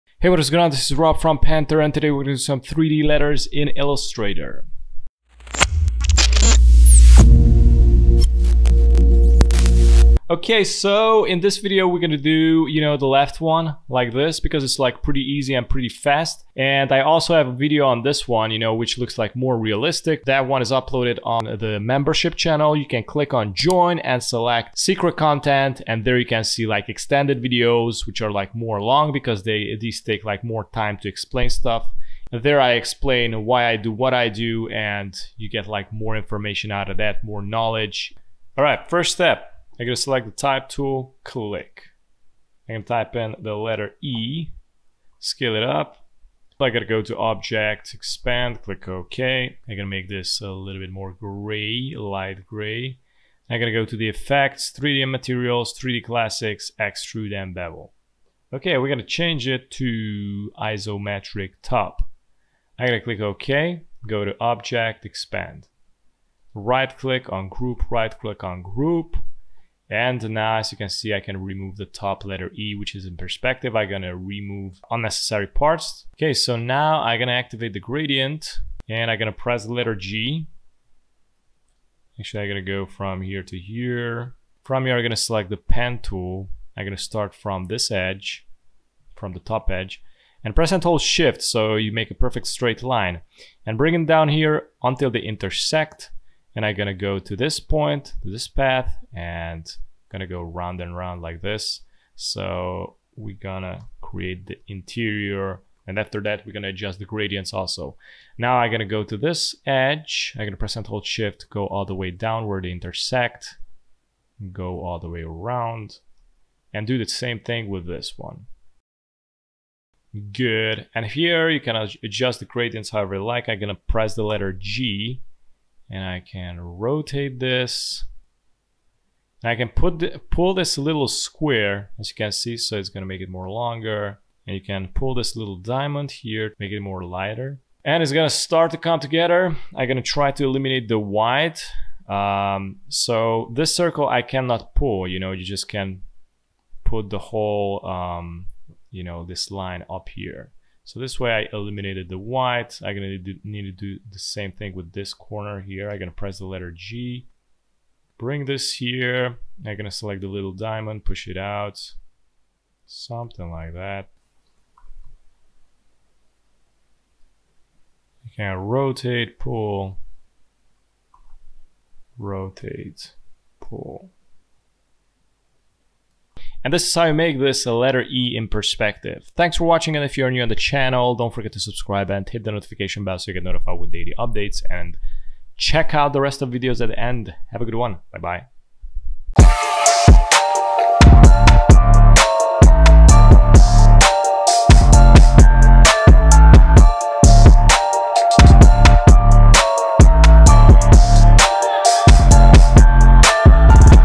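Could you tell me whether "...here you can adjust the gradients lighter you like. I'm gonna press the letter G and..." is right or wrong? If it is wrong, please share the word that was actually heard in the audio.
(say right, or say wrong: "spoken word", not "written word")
wrong: "however", not "lighter".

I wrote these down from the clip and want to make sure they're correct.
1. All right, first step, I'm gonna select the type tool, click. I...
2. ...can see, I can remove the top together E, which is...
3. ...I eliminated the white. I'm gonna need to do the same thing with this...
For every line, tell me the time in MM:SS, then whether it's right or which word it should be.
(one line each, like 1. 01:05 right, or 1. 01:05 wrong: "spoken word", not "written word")
1. 00:38 right
2. 01:10 wrong: "letter", not "together"
3. 02:31 right.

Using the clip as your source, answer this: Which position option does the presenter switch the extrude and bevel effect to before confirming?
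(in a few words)
Isometric top.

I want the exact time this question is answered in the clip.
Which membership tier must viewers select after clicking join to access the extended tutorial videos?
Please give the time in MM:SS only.
00:24.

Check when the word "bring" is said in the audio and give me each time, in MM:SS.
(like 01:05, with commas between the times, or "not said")
01:33, 02:38.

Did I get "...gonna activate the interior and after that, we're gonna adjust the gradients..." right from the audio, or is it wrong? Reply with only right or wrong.
wrong.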